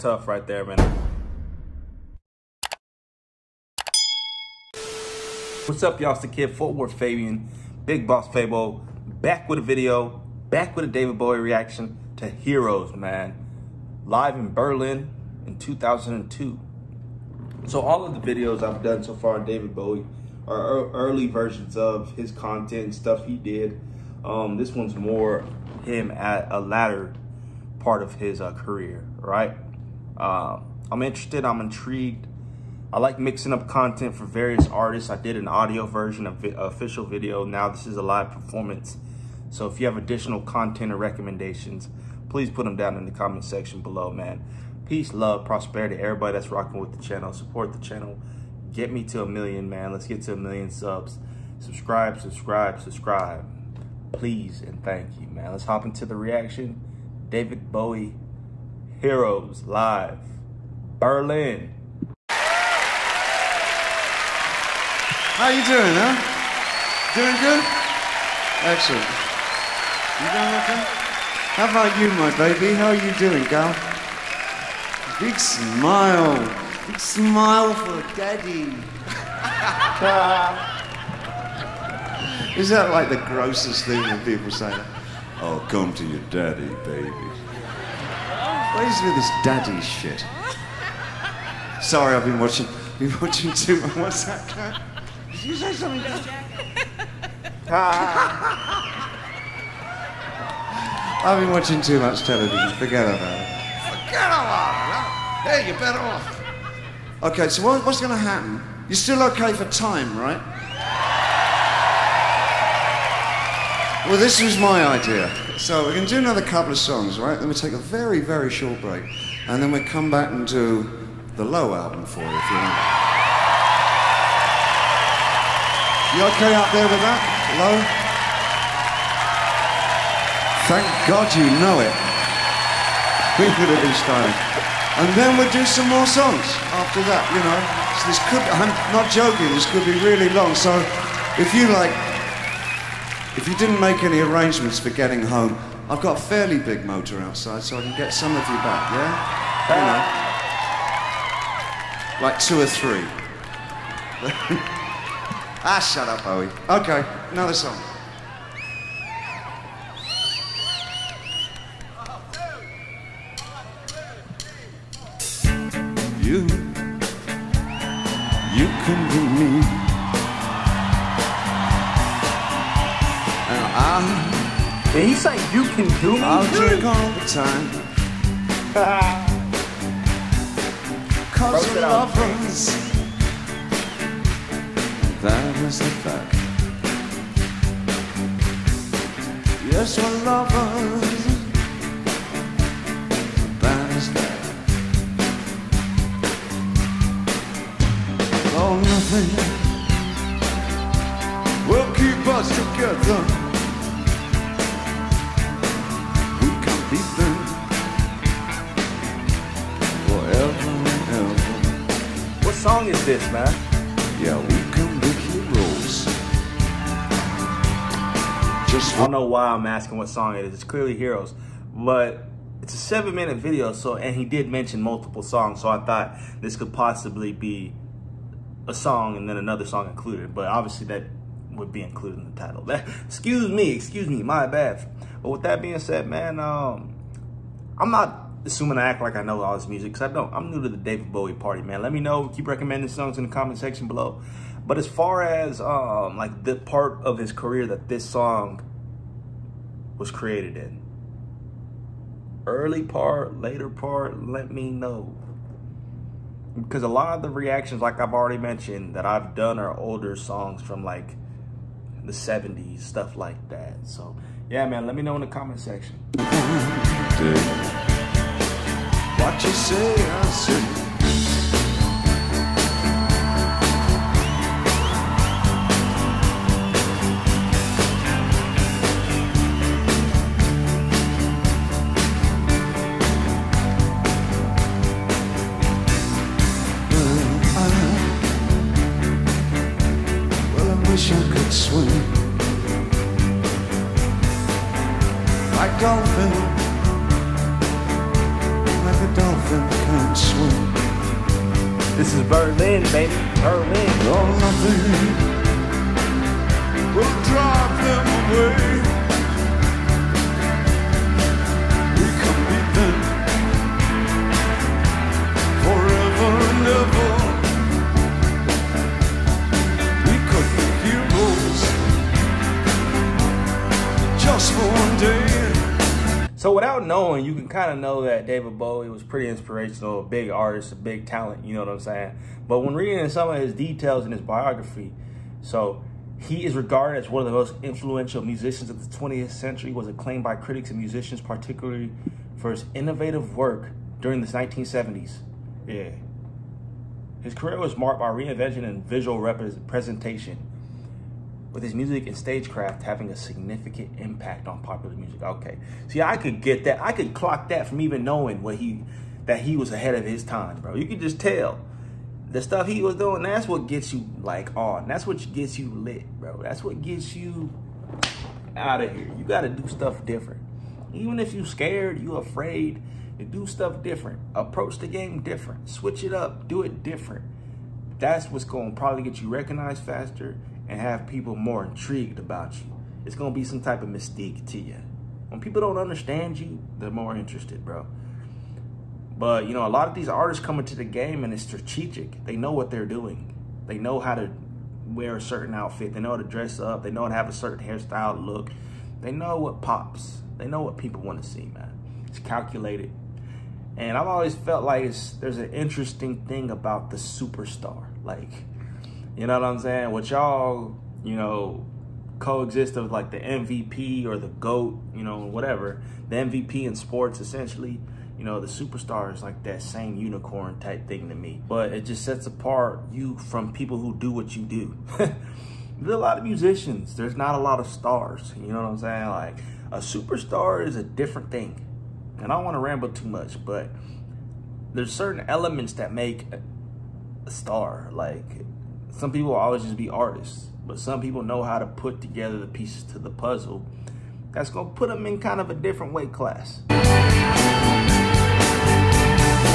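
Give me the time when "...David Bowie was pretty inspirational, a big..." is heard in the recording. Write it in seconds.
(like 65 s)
328 s.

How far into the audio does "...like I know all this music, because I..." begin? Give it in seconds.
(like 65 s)
239 s.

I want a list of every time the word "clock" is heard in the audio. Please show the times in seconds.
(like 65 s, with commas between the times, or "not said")
357 s.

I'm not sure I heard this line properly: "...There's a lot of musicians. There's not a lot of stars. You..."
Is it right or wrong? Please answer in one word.
right.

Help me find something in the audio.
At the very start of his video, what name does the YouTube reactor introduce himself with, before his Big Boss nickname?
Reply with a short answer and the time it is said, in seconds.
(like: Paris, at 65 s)
Worth Fabian, at 6 s.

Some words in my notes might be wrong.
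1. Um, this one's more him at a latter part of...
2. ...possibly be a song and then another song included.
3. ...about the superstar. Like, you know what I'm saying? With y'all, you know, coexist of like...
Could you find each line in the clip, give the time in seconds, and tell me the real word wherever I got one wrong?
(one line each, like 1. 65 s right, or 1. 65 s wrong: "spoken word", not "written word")
1. 24 s right
2. 226 s right
3. 406 s right.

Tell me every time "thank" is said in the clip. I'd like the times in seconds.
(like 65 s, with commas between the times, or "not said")
54 s, 130 s.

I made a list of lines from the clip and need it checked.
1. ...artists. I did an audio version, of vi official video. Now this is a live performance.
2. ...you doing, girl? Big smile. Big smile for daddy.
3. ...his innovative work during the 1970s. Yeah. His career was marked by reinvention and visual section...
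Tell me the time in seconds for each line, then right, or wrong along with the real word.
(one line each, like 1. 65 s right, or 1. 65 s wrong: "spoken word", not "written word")
1. 34 s right
2. 72 s right
3. 342 s wrong: "representation", not "section".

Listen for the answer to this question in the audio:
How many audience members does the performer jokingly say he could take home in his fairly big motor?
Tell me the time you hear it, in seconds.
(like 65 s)
152 s.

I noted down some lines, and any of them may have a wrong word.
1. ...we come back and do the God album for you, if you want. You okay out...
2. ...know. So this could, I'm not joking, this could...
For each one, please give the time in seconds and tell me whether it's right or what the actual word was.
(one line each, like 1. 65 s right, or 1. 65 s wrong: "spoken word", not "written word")
1. 119 s wrong: "Low", not "God"
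2. 137 s right.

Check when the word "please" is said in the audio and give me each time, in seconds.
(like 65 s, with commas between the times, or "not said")
42 s, 54 s.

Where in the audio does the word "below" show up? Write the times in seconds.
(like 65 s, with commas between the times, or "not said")
43 s, 243 s.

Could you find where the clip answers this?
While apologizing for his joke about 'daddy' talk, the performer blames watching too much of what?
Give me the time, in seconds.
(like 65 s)
102 s.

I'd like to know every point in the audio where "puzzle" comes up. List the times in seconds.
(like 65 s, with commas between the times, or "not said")
443 s.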